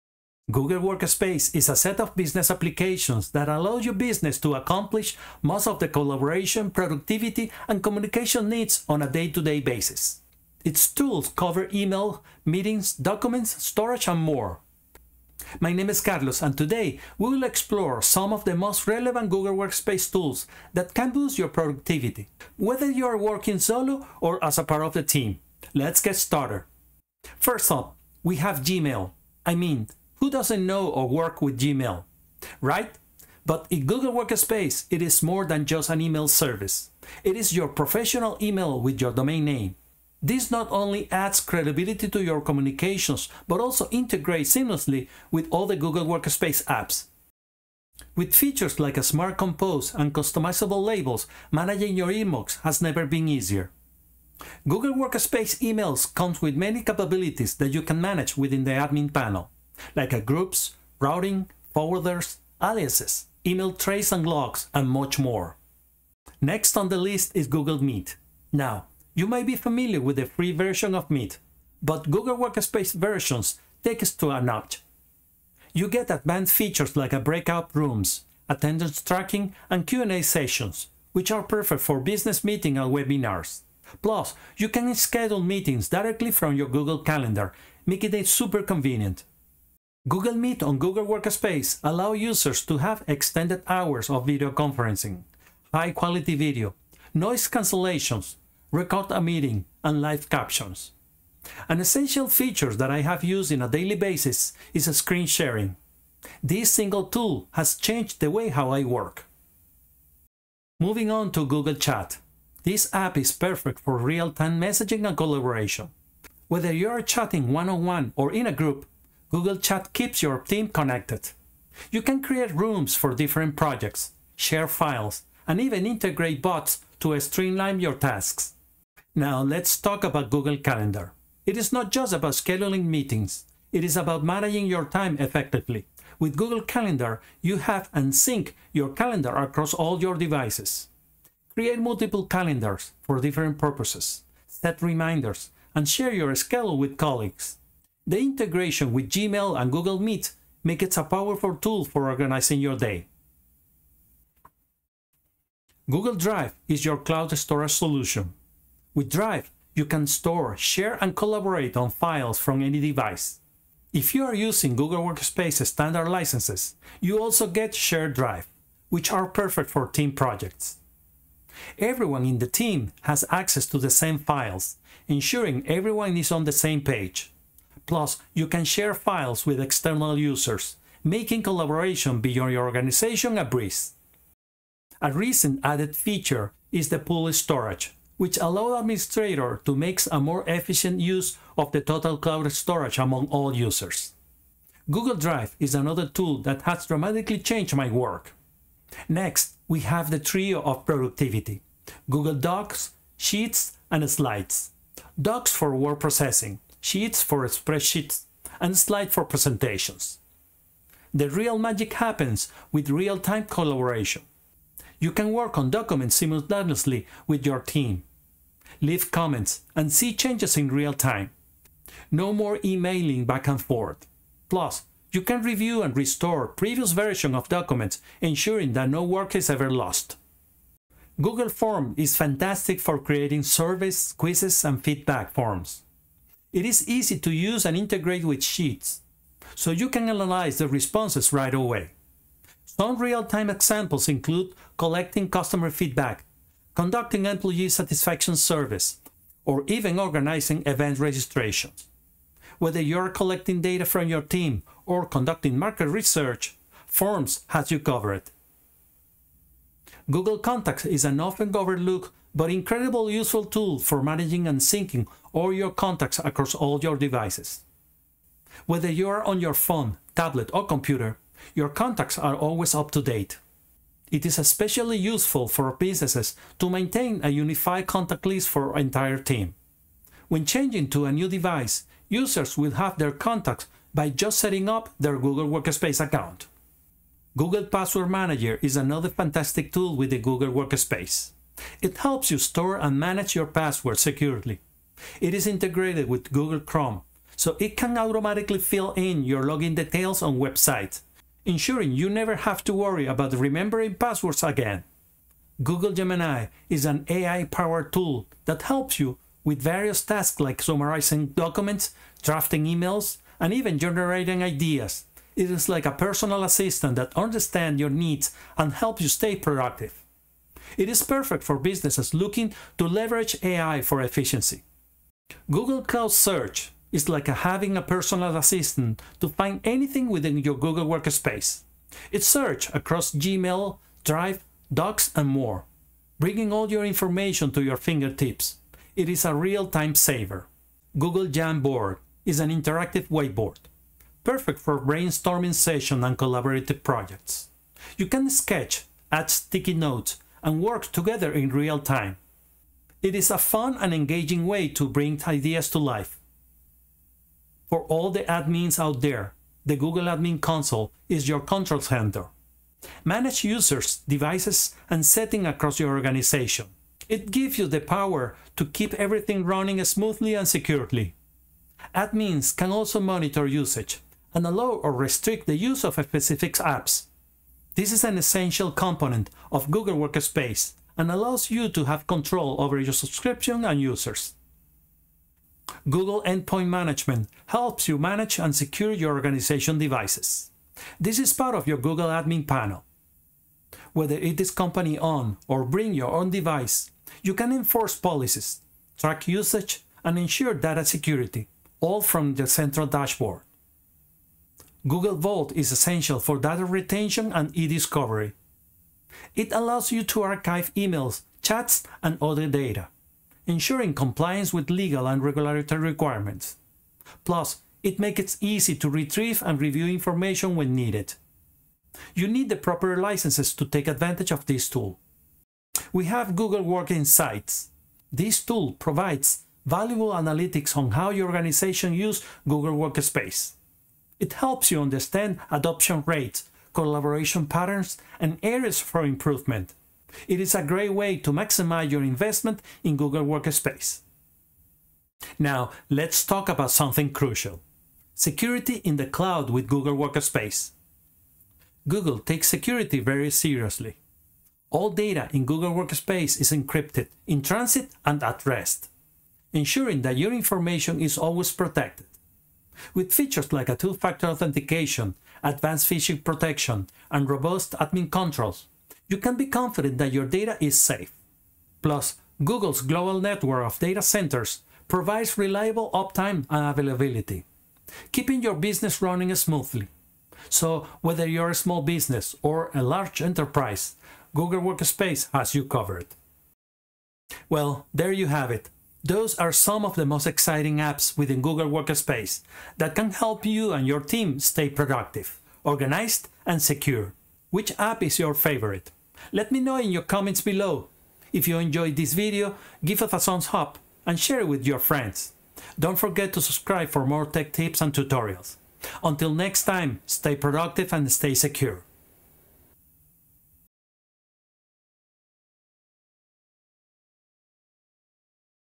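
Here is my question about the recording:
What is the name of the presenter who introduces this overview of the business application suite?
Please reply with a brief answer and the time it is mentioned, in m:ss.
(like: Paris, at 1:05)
Carlos, at 0:16.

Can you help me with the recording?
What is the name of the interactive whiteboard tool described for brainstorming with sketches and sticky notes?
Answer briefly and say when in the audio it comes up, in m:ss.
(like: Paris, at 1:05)
Google Jamboard, at 5:40.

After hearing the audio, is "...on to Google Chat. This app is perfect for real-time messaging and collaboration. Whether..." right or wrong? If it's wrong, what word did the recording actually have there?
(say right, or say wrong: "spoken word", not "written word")
right.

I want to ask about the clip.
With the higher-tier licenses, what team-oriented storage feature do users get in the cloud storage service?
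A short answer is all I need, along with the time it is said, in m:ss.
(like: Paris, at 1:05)
Shared Drive, at 2:47.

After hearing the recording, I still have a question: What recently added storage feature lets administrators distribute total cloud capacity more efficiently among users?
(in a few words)
pool storage.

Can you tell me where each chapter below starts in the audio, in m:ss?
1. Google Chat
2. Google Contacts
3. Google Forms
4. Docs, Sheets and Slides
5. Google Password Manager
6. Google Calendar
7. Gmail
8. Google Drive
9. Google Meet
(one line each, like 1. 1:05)
1. 1:50
2. 4:19
3. 3:50
4. 3:18
5. 4:47
6. 2:09
7. 0:27
8. 2:35
9. 1:06.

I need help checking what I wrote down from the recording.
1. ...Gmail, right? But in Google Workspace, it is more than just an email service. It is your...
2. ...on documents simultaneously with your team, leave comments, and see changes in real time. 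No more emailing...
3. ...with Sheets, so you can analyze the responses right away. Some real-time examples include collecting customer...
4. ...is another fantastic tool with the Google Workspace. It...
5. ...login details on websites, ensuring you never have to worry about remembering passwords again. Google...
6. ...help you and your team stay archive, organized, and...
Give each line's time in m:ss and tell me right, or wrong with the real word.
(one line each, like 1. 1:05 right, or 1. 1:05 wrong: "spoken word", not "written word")
1. 0:31 right
2. 3:35 right
3. 3:58 right
4. 4:48 right
5. 4:59 right
6. 8:13 wrong: "productive", not "archive".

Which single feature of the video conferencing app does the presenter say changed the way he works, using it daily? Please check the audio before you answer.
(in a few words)
screen sharing.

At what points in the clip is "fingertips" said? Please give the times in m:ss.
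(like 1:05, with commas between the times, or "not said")
5:37.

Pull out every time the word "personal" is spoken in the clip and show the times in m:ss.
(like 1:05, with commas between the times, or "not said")
5:15, 5:27.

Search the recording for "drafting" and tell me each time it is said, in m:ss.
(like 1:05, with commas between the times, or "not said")
5:12.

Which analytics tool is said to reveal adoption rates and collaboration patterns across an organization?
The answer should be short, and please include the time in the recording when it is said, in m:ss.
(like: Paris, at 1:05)
Google Work Insights, at 7:06.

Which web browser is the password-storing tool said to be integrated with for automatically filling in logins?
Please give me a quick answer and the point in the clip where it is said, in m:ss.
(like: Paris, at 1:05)
Google Chrome, at 4:56.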